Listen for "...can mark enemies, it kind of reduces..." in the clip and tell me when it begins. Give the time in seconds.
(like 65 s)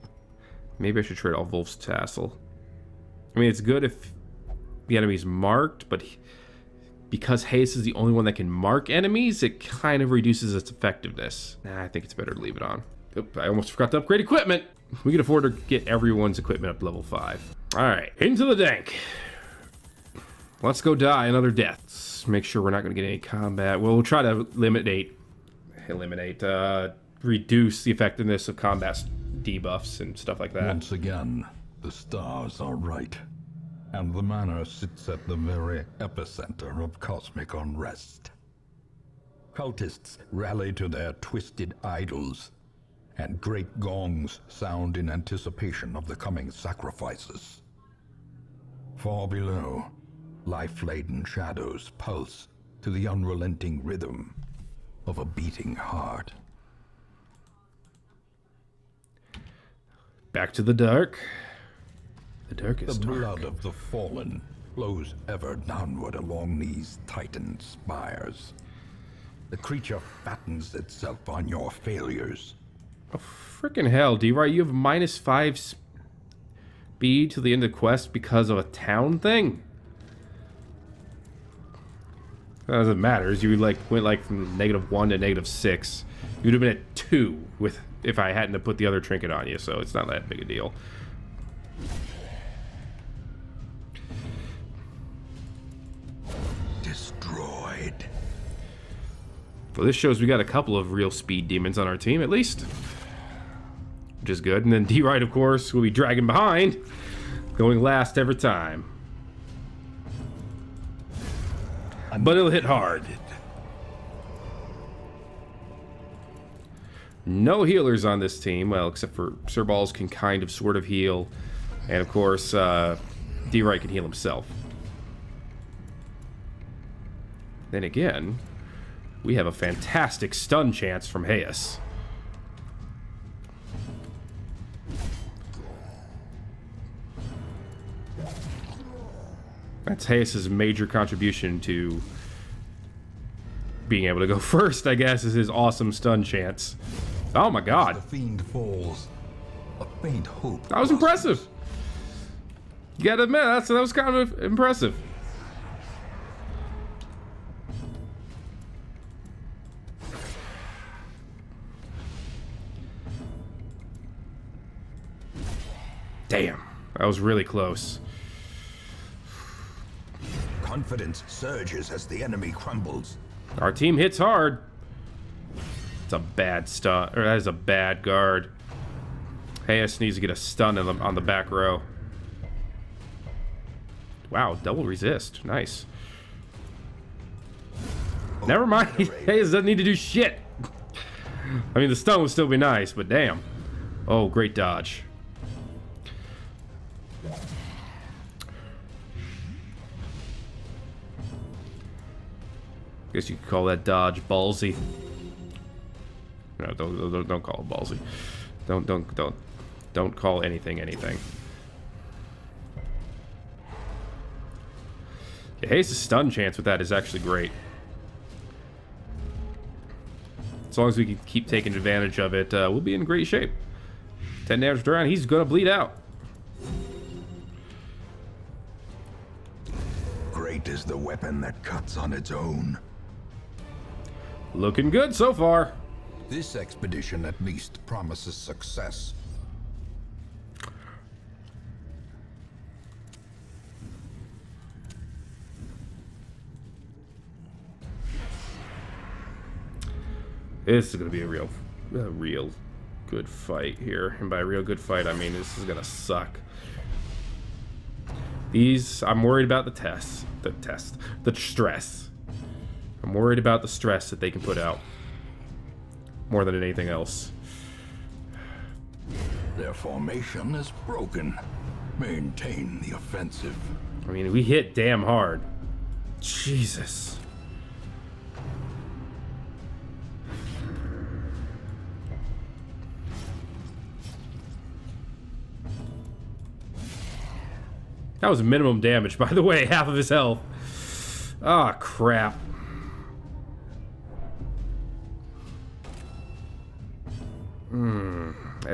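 8 s.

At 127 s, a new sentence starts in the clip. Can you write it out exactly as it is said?
Then again, we have a fantastic stun chance from Hayes.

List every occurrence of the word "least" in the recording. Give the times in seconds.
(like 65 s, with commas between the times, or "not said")
102 s, 237 s.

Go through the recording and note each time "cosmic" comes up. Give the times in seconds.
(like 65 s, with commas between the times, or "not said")
36 s.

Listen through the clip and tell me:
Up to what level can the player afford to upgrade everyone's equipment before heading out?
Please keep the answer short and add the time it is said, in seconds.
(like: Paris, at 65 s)
5, at 16 s.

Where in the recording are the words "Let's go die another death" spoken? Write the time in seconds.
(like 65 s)
20 s.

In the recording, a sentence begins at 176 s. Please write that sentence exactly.
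It's a bad stun, or that is a bad guard.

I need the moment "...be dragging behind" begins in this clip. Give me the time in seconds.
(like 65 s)
105 s.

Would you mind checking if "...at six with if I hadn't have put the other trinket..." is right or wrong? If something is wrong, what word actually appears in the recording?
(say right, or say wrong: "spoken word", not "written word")
wrong: "two", not "six".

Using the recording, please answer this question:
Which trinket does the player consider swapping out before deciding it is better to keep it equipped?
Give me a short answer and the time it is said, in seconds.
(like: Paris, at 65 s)
Wolf's Tassel, at 1 s.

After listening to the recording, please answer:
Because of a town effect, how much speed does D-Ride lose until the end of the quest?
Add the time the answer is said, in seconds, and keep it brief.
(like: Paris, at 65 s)
minus 5, at 74 s.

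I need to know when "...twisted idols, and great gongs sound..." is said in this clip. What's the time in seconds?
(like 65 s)
41 s.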